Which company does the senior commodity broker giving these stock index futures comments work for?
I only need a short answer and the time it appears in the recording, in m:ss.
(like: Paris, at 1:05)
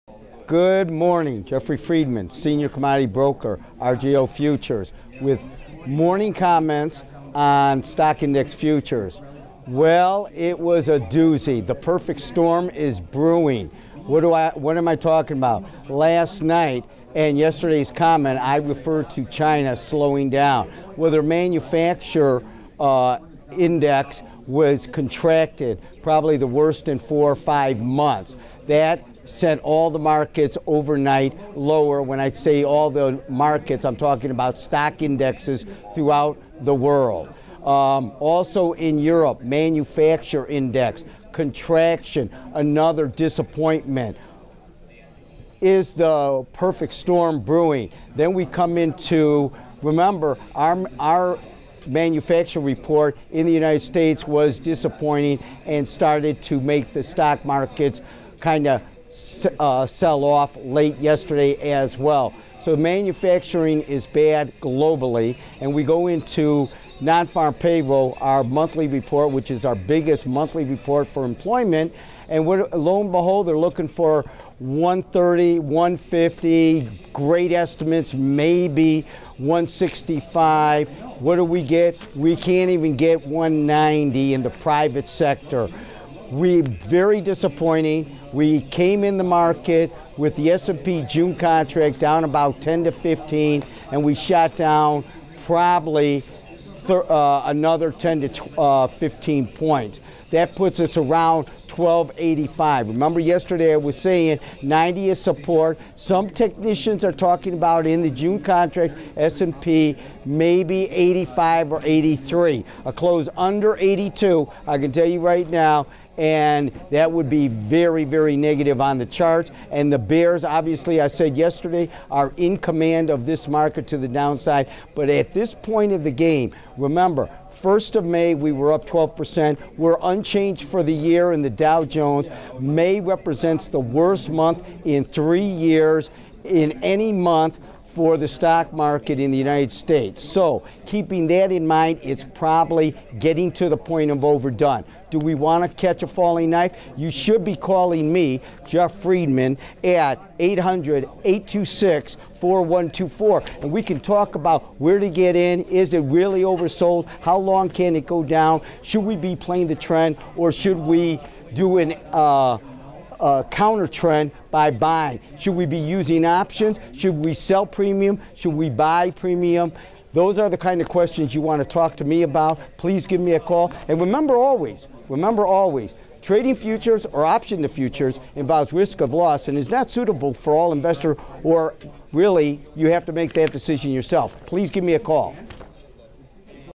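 RJO Futures, at 0:03.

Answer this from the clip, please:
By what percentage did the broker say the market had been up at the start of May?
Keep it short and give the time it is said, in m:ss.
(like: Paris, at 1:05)
12%, at 2:08.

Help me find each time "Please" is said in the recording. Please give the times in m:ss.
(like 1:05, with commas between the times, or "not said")
2:52, 3:04.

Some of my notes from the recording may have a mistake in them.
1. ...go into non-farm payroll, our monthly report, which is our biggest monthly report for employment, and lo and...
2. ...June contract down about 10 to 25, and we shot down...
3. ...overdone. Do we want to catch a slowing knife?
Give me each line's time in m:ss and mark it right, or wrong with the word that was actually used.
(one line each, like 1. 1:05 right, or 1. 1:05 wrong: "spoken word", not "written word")
1. 1:05 right
2. 1:31 wrong: "15", not "25"
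3. 2:24 wrong: "falling", not "slowing".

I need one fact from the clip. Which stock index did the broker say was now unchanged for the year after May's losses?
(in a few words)
Dow Jones.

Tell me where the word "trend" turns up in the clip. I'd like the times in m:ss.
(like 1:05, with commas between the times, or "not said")
2:39, 2:43.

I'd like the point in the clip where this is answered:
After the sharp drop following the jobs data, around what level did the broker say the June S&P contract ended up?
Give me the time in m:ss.
1:41.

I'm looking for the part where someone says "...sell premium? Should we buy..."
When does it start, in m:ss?
2:47.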